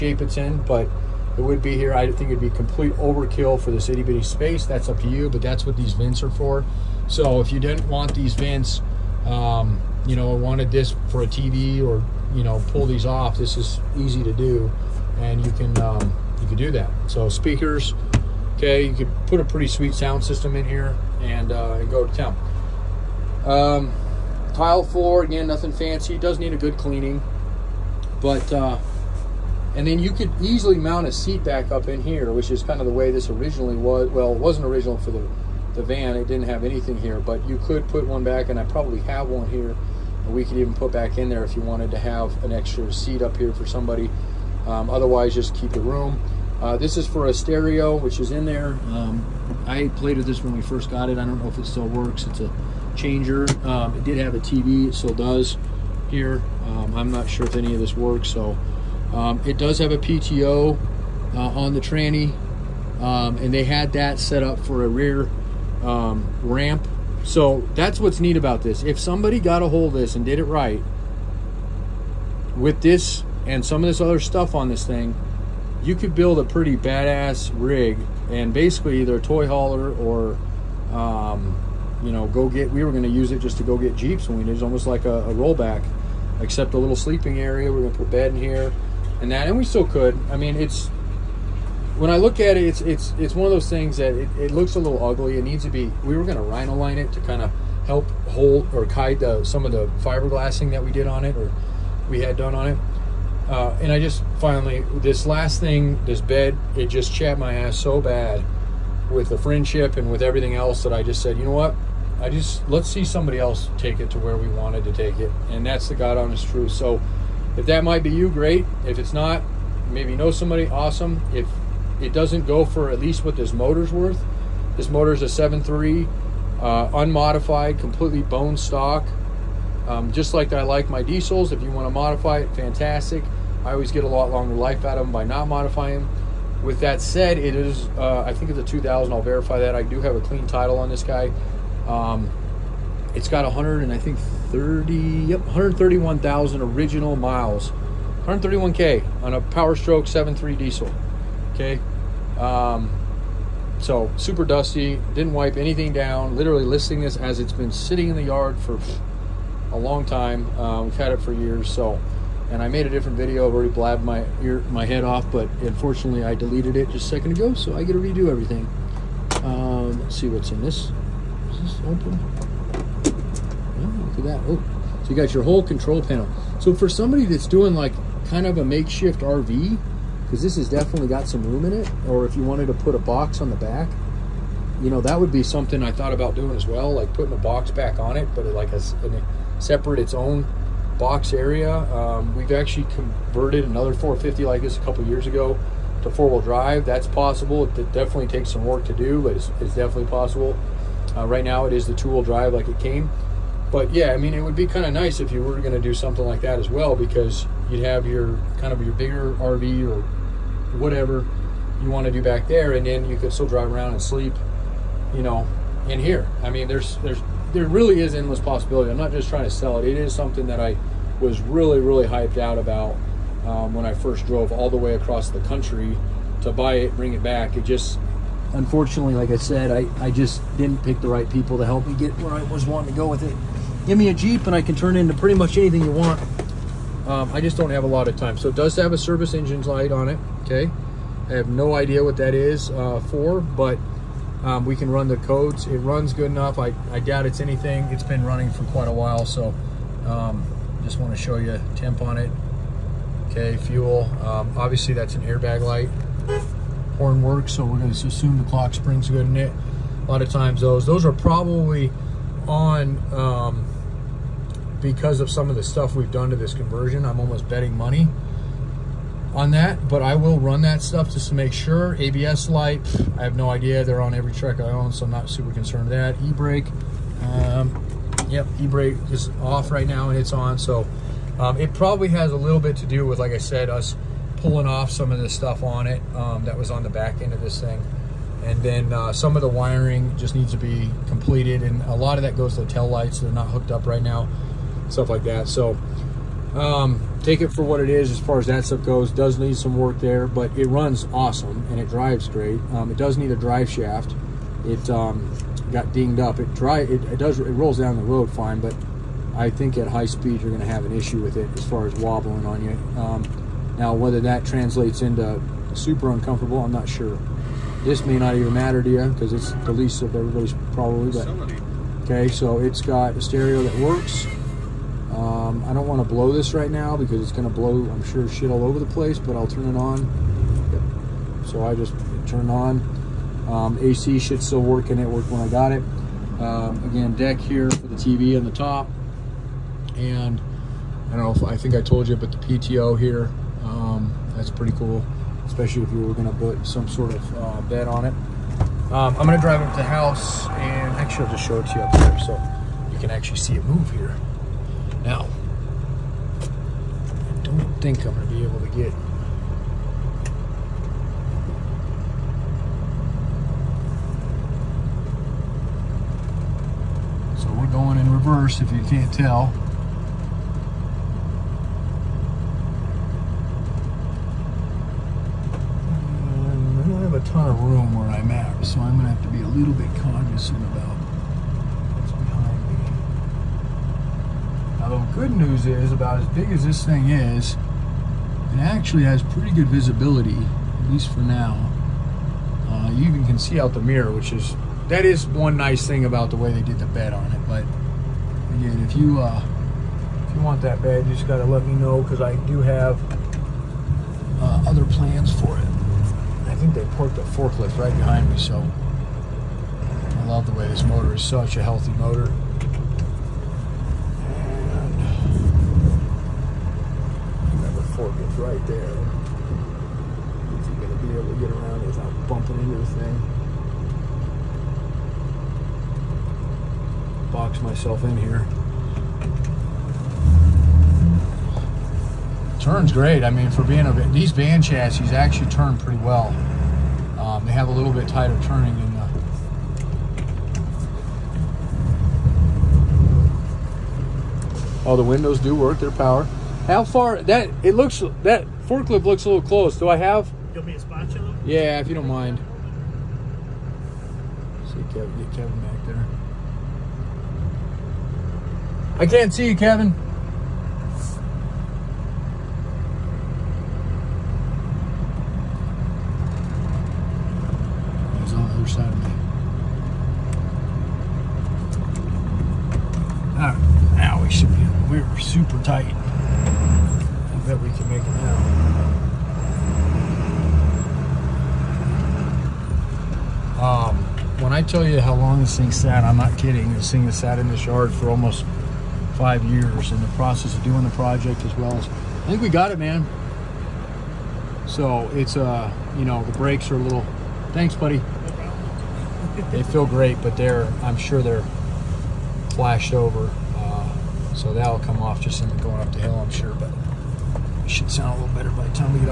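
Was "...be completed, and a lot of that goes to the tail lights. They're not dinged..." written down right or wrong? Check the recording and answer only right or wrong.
wrong.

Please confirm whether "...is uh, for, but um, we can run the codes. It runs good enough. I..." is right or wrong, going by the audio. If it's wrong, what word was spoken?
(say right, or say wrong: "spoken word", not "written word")
right.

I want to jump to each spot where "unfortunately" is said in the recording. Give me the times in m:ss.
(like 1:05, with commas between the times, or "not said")
2:45, 3:48.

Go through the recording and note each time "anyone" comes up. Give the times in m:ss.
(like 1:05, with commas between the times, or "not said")
not said.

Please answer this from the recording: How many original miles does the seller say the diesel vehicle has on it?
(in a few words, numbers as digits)
131,000.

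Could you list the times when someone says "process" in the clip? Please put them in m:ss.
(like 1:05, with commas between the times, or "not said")
8:10.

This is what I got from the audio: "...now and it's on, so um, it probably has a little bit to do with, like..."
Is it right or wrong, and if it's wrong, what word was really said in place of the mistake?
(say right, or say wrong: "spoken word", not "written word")
right.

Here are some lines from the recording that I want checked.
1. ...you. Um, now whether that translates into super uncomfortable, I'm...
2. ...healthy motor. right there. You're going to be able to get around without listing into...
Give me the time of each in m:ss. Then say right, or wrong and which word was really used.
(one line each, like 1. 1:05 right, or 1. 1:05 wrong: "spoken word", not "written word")
1. 5:12 right
2. 6:51 wrong: "bumping", not "listing".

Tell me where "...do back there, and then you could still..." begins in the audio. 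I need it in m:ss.
3:32.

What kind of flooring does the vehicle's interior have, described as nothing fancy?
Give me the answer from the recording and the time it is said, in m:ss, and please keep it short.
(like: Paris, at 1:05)
tile floor, at 0:24.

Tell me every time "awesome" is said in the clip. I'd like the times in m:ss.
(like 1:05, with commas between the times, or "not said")
2:00, 5:01.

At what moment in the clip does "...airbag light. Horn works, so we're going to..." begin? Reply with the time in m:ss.
4:15.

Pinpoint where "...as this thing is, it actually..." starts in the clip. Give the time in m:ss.
6:26.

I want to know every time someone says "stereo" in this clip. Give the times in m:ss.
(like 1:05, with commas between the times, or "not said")
0:47, 5:23.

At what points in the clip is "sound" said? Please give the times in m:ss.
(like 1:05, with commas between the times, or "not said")
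0:19, 8:27.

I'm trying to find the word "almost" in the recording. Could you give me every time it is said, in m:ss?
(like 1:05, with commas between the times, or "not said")
1:24, 4:27, 8:08.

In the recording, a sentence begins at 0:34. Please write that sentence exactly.
Well, it wasn't original for the the van.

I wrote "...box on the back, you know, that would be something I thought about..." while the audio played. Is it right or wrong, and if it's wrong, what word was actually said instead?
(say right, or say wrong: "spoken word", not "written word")
right.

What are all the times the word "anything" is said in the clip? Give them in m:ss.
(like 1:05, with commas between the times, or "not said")
0:36, 2:35, 3:55, 4:07.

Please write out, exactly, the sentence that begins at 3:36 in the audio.
I mean, there's there's there really is endless possibility.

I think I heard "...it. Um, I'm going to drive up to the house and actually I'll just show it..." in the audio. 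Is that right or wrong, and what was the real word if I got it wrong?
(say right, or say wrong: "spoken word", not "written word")
right.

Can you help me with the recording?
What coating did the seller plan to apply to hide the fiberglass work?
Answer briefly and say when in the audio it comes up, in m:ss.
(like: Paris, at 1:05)
rhino line, at 1:36.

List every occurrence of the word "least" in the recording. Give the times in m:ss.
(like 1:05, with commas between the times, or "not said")
2:02, 5:19, 6:30.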